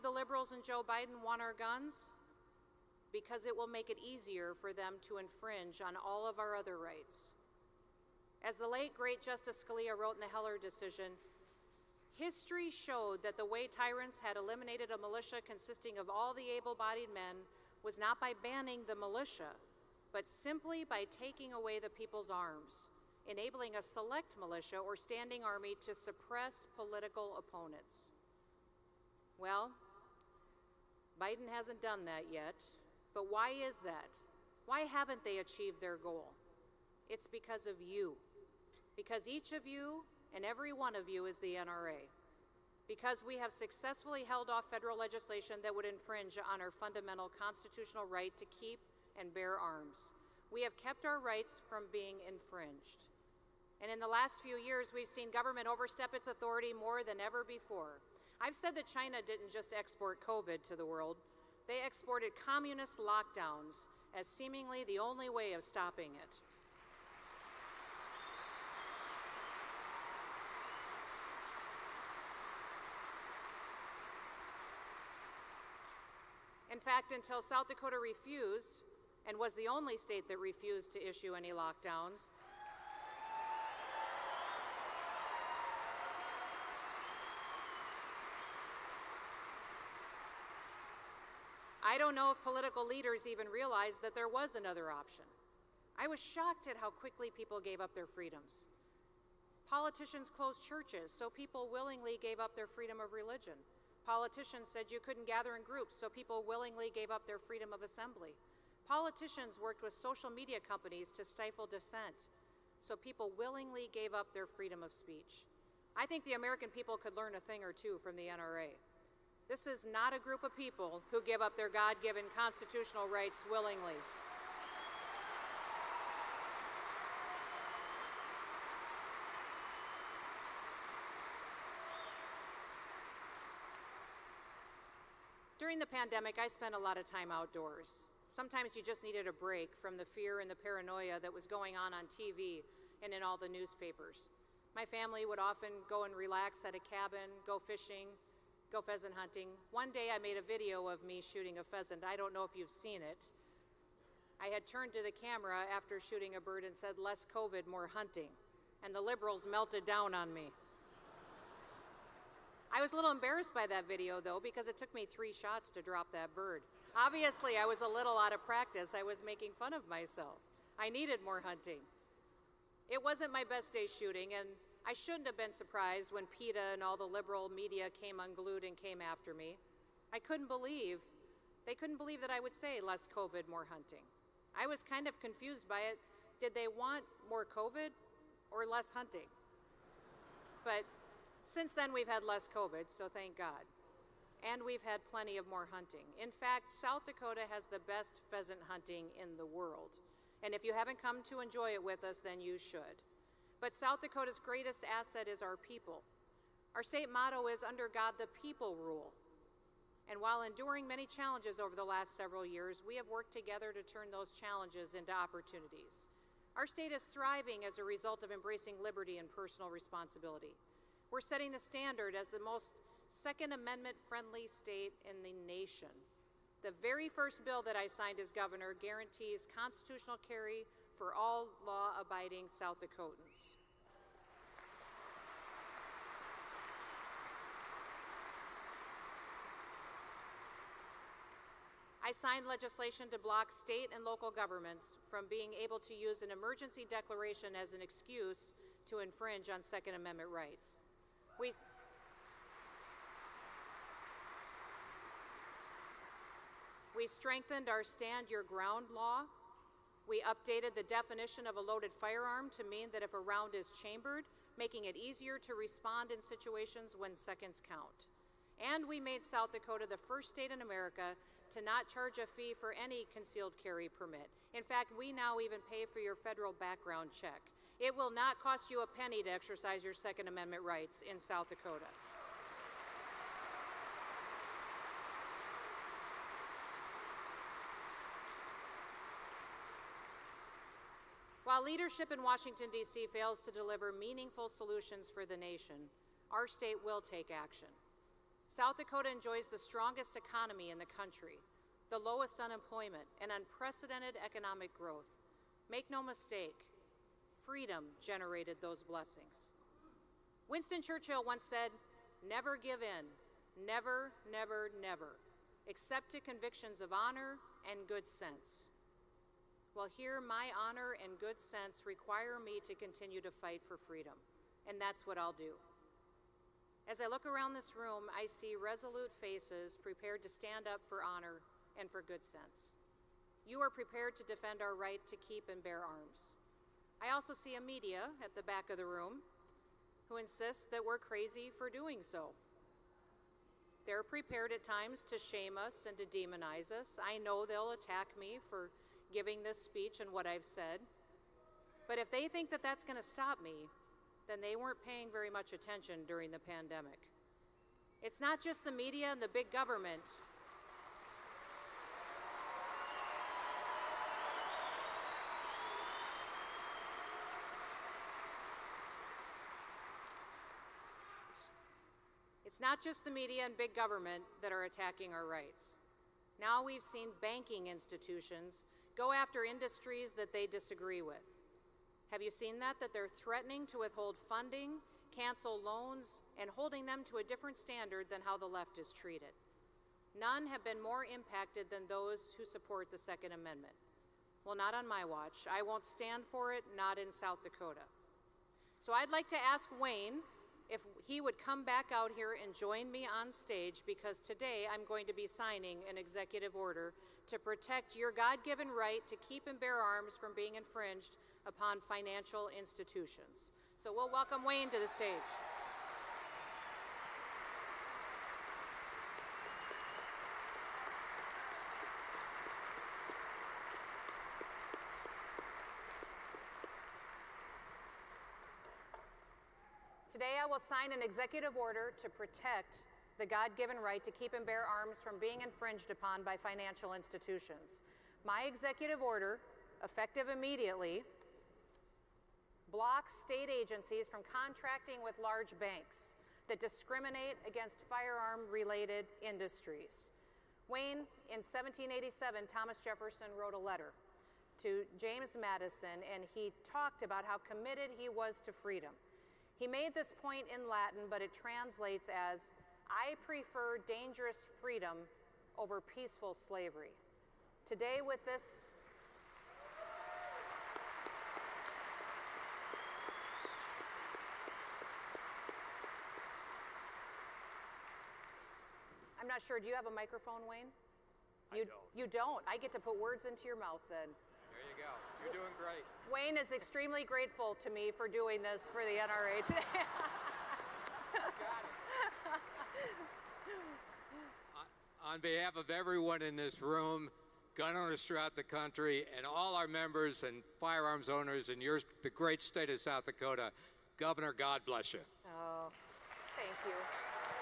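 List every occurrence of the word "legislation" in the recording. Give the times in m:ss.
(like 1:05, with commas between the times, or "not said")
0:44, 4:02.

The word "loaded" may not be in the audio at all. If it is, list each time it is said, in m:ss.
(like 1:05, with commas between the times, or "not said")
4:21.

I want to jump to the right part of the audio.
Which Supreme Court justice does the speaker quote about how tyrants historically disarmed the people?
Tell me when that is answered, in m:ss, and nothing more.
0:09.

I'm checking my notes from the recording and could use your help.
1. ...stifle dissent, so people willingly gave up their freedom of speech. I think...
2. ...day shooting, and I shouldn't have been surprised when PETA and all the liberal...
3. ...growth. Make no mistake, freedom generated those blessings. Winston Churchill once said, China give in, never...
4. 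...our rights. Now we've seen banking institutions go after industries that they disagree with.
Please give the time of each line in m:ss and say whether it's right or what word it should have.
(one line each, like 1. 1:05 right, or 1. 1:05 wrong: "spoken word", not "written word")
1. 1:51 right
2. 2:53 right
3. 5:04 wrong: "Never", not "China"
4. 6:15 right.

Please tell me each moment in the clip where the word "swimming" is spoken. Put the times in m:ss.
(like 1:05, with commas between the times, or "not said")
not said.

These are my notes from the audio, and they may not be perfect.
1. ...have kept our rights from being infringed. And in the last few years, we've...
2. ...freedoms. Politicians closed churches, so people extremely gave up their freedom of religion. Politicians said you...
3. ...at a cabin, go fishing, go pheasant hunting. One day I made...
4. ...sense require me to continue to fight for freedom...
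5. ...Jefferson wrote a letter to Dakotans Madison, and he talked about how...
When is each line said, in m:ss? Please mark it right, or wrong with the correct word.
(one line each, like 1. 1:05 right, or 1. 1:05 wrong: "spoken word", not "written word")
1. 0:50 right
2. 1:38 wrong: "willingly", not "extremely"
3. 2:26 right
4. 5:21 right
5. 7:32 wrong: "James", not "Dakotans".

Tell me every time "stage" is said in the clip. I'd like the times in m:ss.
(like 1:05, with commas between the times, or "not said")
6:43, 6:54.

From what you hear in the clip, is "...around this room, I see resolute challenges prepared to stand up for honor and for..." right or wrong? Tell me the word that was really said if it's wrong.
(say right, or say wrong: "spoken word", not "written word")
wrong: "faces", not "challenges".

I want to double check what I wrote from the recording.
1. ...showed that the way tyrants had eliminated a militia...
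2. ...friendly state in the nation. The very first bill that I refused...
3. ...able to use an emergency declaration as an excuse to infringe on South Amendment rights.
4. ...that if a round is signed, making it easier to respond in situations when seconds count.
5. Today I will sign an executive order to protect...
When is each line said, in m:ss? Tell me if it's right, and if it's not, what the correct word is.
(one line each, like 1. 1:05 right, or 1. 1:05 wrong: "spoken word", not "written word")
1. 0:12 right
2. 3:44 wrong: "signed", not "refused"
3. 4:05 wrong: "Second", not "South"
4. 4:22 wrong: "chambered", not "signed"
5. 7:10 right.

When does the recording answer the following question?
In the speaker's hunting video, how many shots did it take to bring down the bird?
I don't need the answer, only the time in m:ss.
2:45.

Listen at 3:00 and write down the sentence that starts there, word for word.
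I couldn't believe, they couldn't believe that I would say less COVID, more hunting.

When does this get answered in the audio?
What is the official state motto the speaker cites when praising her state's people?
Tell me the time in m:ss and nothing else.
3:27.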